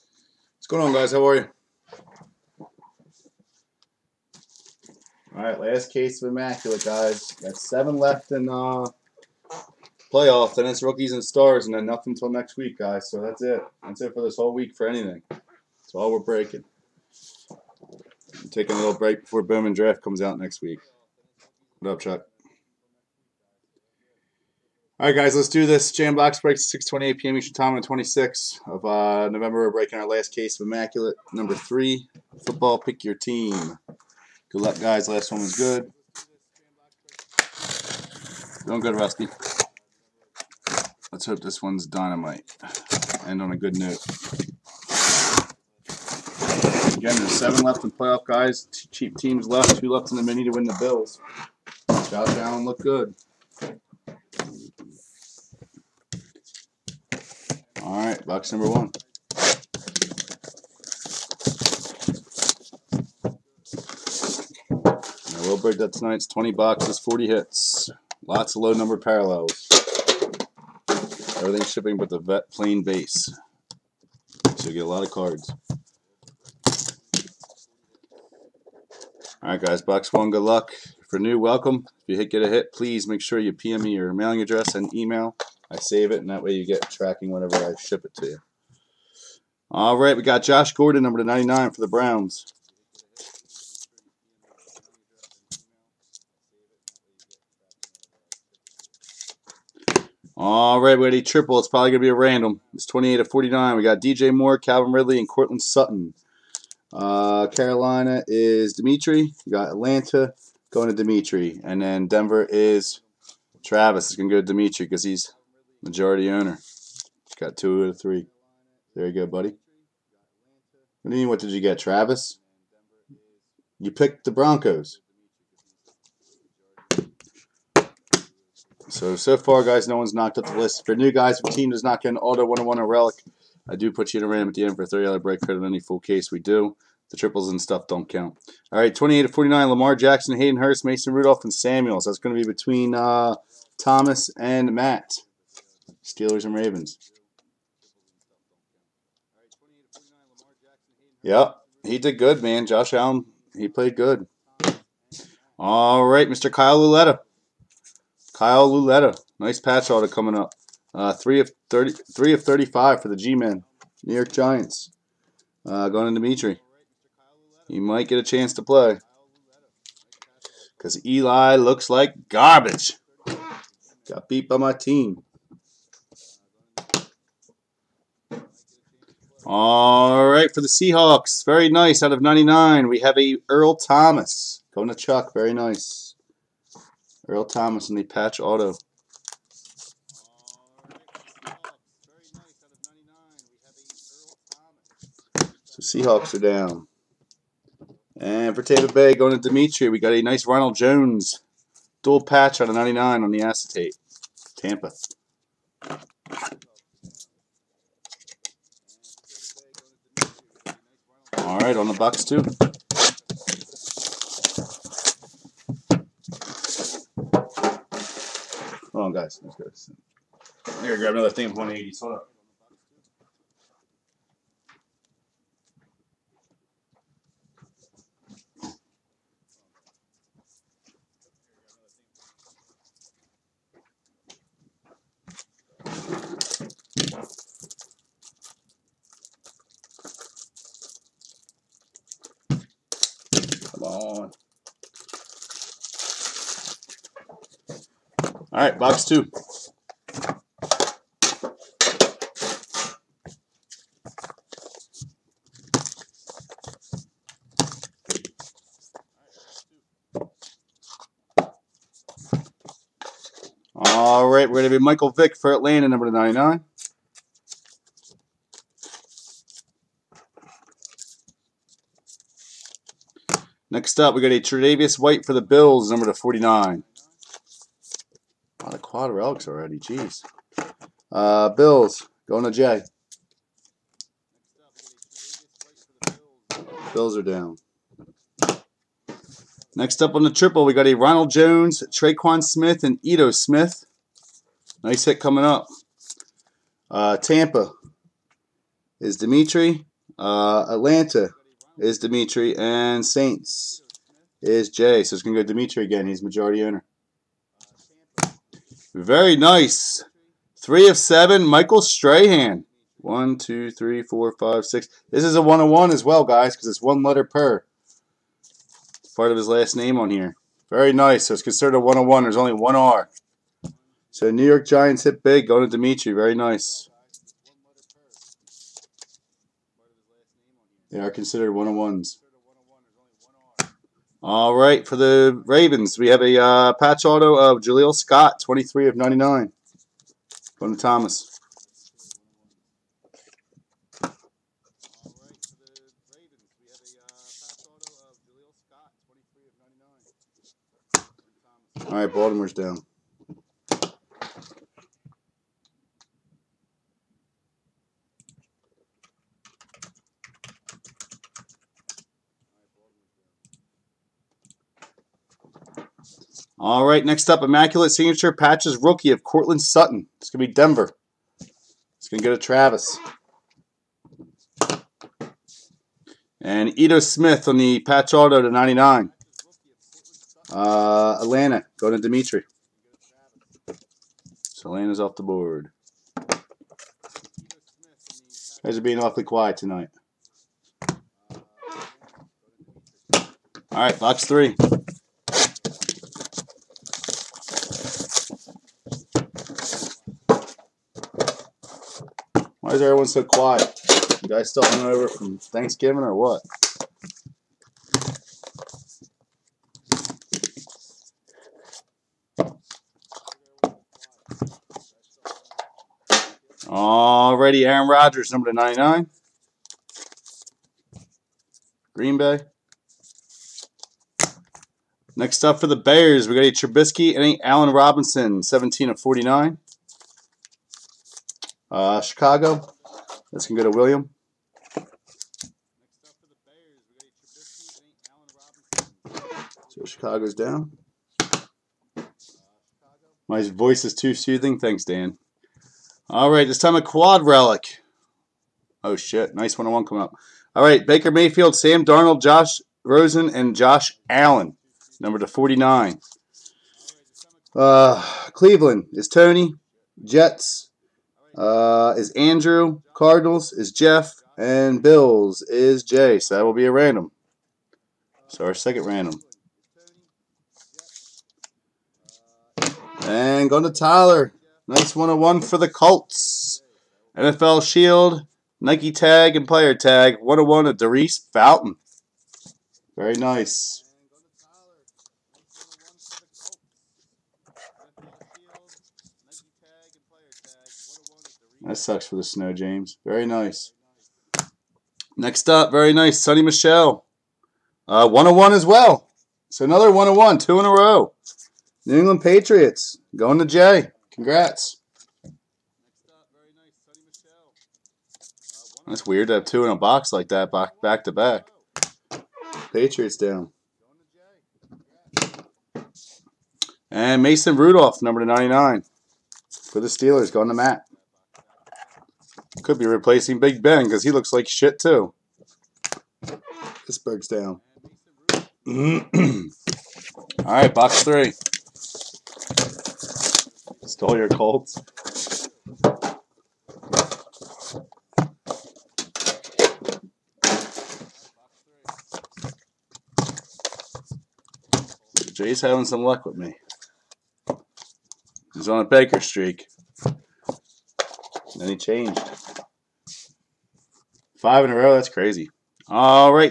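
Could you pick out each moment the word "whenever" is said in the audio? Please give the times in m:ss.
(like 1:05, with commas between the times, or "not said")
1:27.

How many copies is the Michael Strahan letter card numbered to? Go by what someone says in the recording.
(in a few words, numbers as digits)
7.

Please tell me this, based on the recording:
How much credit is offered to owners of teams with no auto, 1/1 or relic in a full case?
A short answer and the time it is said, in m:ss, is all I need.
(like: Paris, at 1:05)
$30, at 2:14.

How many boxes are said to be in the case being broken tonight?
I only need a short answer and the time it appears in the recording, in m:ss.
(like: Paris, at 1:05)
20, at 1:06.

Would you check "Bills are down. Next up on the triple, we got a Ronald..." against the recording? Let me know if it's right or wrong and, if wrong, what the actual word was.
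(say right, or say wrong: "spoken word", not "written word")
right.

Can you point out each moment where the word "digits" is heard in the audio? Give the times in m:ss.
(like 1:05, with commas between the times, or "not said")
not said.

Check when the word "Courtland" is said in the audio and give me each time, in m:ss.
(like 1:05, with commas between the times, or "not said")
1:45, 6:09.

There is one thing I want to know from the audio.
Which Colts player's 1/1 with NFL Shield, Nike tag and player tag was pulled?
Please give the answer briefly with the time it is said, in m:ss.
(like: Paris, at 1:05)
Daurice Fountain, at 8:00.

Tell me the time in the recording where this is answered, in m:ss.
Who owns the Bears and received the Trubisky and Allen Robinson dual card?
7:13.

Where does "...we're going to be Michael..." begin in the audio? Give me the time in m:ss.
4:24.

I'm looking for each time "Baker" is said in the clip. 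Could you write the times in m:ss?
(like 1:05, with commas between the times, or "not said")
7:30, 9:08.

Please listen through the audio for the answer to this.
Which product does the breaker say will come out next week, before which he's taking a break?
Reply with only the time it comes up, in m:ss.
0:19.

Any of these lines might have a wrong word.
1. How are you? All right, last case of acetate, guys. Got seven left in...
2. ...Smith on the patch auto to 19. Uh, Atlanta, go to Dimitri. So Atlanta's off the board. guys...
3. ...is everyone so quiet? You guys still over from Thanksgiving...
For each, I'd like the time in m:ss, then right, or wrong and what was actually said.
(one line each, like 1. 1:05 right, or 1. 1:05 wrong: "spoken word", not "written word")
1. 0:01 wrong: "immaculate", not "acetate"
2. 6:16 wrong: "99", not "19"
3. 6:42 right.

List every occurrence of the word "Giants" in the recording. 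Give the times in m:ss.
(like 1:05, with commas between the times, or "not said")
2:44, 5:24.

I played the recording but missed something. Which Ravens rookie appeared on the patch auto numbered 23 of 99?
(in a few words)
Jaleel Scott.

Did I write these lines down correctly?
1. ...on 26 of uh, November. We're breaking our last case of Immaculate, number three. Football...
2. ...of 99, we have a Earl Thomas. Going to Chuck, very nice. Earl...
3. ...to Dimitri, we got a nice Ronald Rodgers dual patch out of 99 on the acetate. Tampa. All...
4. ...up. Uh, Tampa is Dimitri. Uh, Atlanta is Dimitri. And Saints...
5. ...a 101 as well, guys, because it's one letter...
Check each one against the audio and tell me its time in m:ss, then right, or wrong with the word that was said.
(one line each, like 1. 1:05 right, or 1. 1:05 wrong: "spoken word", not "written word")
1. 0:27 right
2. 3:02 right
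3. 3:19 wrong: "Jones", not "Rodgers"
4. 4:55 right
5. 5:15 right.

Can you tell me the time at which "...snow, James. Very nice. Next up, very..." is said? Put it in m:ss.
8:12.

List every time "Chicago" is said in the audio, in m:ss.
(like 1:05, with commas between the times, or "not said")
7:12, 7:19.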